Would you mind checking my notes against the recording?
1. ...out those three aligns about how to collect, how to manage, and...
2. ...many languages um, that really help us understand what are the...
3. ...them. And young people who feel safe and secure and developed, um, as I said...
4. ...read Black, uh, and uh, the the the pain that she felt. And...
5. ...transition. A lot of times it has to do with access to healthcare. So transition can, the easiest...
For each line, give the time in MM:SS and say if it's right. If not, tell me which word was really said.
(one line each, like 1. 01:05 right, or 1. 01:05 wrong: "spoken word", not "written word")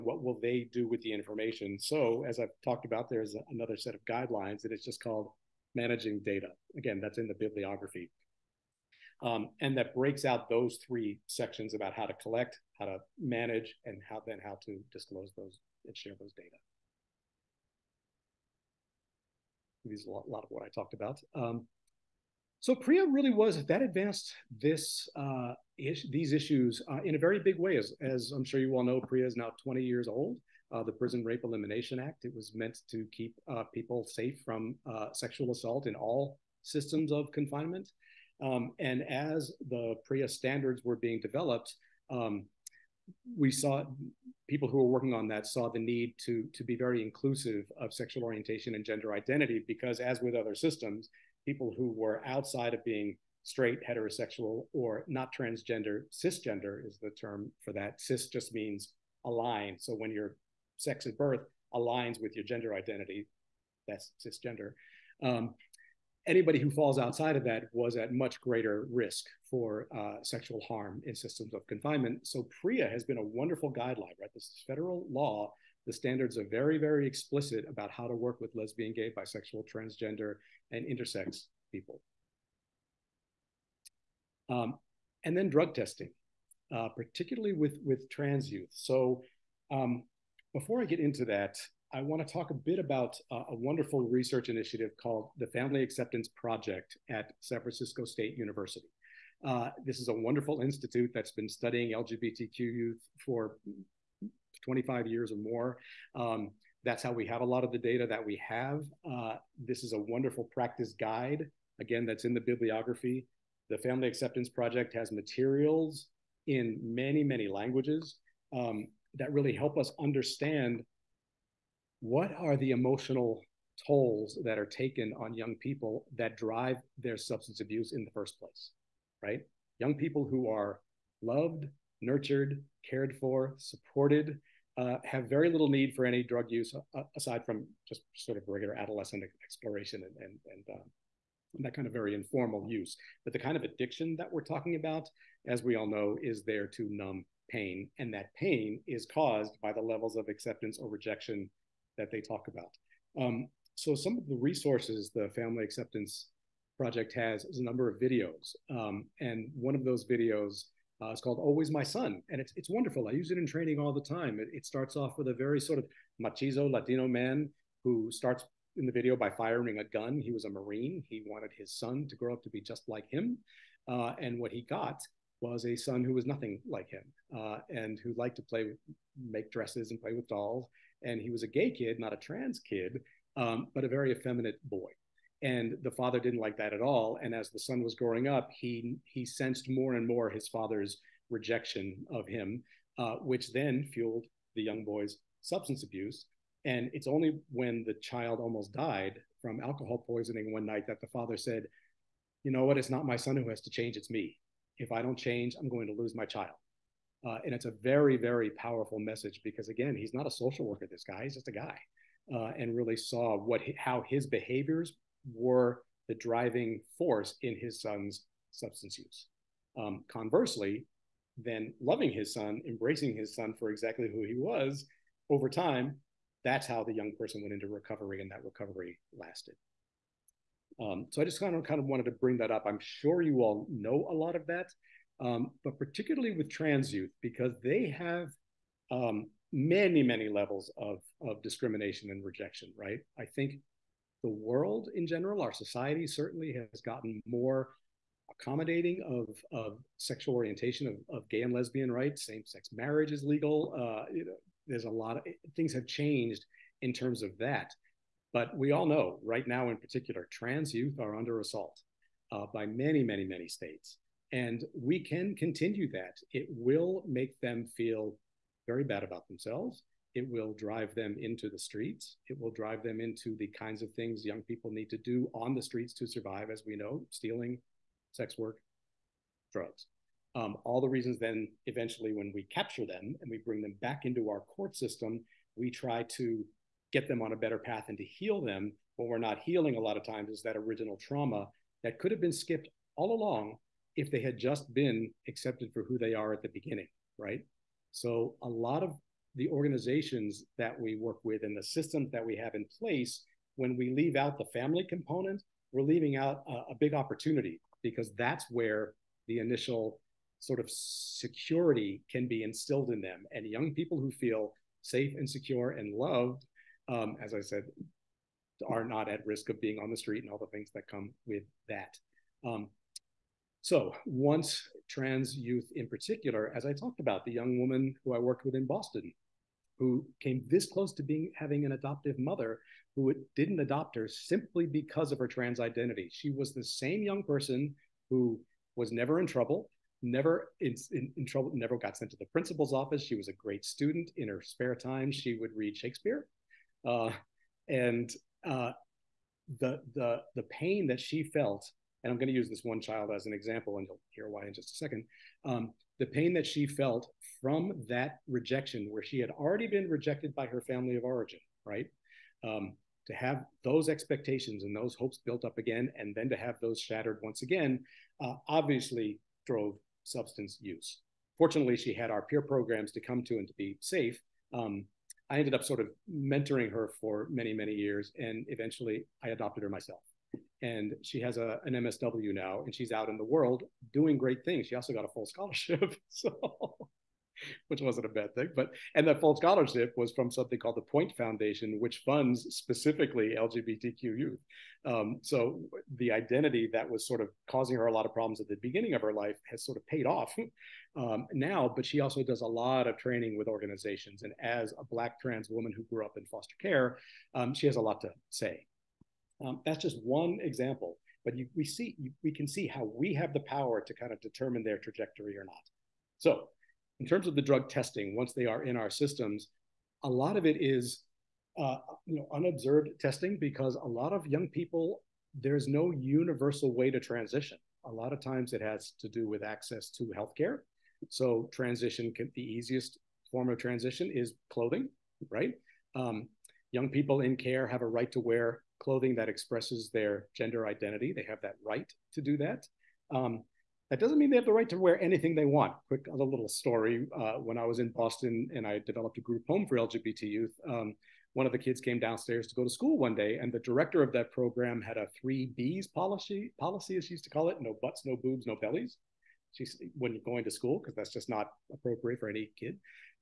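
1. 00:10 wrong: "sections", not "aligns"
2. 01:57 right
3. 05:12 wrong: "loved", not "developed"
4. 05:45 wrong: "Shakespeare", not "Black"
5. 07:06 right.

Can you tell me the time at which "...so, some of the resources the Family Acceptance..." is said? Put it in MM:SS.
02:33.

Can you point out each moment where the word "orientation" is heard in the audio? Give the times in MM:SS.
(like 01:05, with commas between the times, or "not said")
00:48, 04:10.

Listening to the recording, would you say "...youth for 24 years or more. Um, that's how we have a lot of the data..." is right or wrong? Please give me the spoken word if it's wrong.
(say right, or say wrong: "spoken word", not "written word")
wrong: "25", not "24".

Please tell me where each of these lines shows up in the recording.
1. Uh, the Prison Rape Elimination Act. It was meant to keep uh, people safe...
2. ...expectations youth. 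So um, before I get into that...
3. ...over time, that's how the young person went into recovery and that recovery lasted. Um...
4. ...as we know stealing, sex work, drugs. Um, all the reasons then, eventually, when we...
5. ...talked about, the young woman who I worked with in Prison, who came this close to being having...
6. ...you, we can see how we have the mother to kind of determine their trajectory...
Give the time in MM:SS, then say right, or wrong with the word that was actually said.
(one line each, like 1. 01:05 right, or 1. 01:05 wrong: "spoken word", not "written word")
1. 00:30 right
2. 01:28 wrong: "trans", not "expectations"
3. 03:45 right
4. 04:36 right
5. 05:26 wrong: "Boston", not "Prison"
6. 06:51 wrong: "power", not "mother".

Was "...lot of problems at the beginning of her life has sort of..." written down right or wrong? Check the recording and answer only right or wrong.
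right.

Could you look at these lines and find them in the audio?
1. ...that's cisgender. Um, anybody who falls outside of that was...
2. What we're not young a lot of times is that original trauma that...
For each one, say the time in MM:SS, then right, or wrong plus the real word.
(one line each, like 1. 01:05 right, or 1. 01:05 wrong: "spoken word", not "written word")
1. 01:03 right
2. 04:48 wrong: "healing", not "young".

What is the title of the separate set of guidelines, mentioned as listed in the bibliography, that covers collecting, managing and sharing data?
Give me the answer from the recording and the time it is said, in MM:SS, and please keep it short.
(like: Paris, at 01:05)
Managing Data, at 00:05.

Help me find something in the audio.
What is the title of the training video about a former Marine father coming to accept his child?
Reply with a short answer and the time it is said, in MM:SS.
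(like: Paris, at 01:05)
Always My Son, at 02:41.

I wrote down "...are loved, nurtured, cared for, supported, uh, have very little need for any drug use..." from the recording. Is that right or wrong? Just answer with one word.
right.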